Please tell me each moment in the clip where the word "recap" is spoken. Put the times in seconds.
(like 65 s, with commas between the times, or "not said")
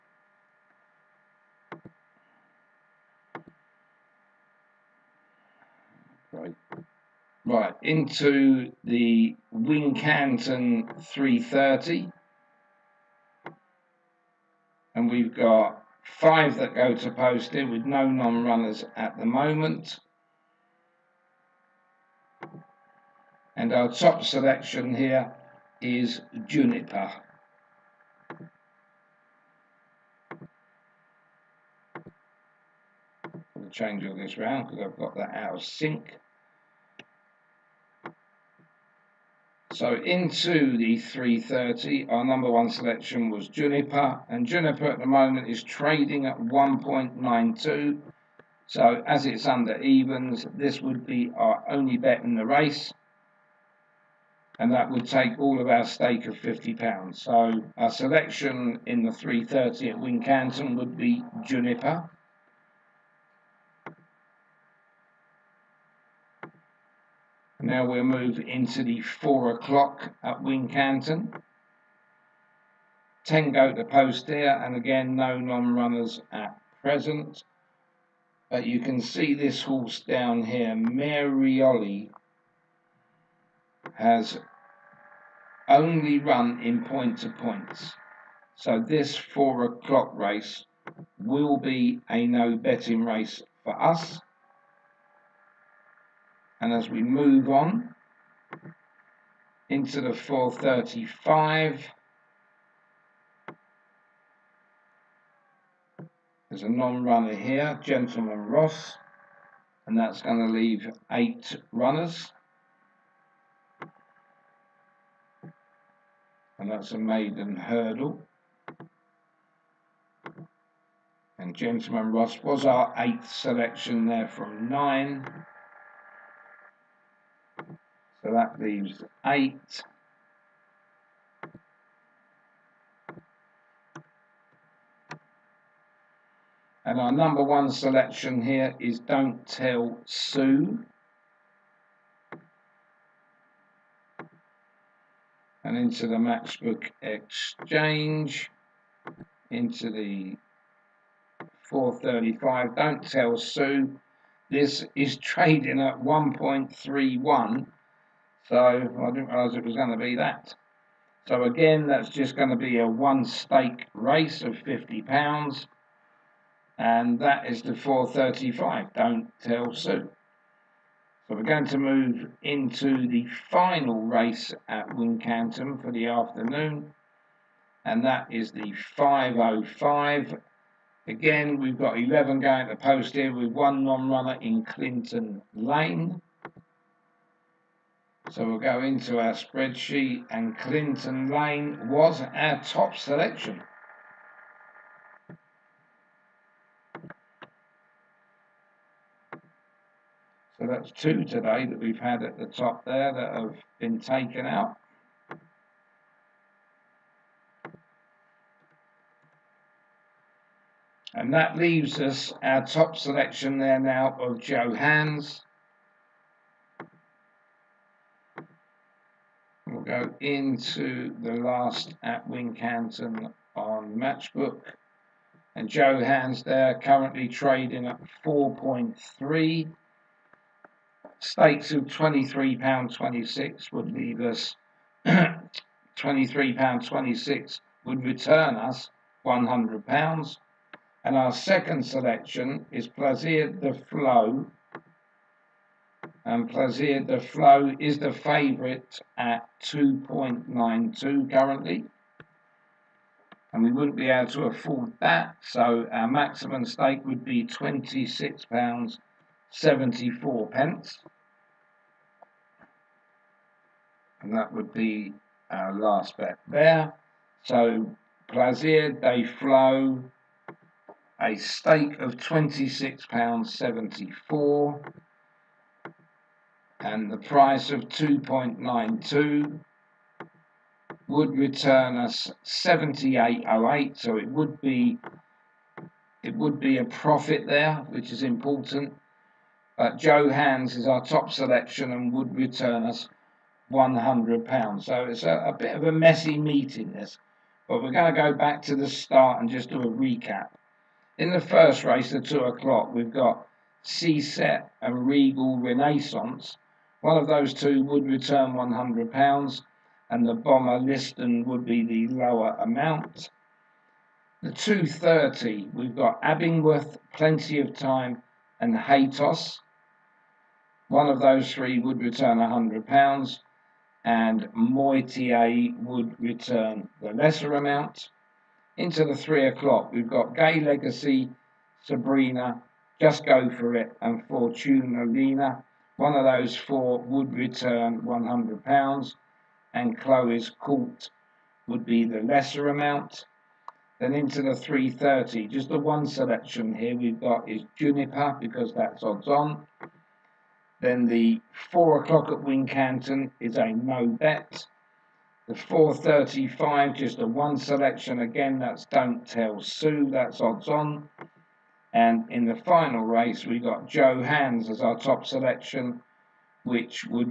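299 s.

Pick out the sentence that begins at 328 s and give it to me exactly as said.
Into the 3 o'clock, we've got Gay Legacy, Sabrina, Just Go For It and Fortuna Lina.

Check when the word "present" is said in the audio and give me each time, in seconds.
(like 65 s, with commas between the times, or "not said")
76 s.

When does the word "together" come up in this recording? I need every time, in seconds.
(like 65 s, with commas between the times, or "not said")
not said.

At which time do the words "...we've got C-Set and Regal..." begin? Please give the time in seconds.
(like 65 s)
302 s.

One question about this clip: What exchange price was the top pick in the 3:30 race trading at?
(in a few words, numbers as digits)
1.92.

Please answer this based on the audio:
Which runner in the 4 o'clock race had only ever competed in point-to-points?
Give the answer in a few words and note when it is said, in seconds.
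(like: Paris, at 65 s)
Marioli, at 80 s.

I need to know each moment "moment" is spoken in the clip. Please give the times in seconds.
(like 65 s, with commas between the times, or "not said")
19 s, 45 s.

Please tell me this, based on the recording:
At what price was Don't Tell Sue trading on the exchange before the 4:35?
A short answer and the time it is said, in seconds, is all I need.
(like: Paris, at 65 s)
1.31, at 156 s.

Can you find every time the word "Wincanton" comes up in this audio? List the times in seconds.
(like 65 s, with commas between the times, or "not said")
9 s, 59 s, 70 s, 174 s, 222 s, 352 s.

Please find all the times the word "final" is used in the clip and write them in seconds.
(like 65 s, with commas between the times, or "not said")
173 s, 362 s.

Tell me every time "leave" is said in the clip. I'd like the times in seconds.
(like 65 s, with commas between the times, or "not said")
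110 s, 128 s, 211 s, 233 s.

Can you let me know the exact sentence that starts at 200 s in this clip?
So that's two today that we've had at the top there that have been taken out.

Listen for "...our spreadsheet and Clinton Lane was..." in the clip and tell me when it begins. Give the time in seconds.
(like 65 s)
189 s.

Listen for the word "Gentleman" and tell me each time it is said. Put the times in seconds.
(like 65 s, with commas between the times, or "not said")
107 s, 121 s.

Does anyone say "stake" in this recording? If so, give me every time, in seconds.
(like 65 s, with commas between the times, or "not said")
55 s, 163 s, 231 s, 256 s, 271 s.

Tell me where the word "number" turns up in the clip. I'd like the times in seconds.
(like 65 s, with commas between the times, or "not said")
42 s, 137 s.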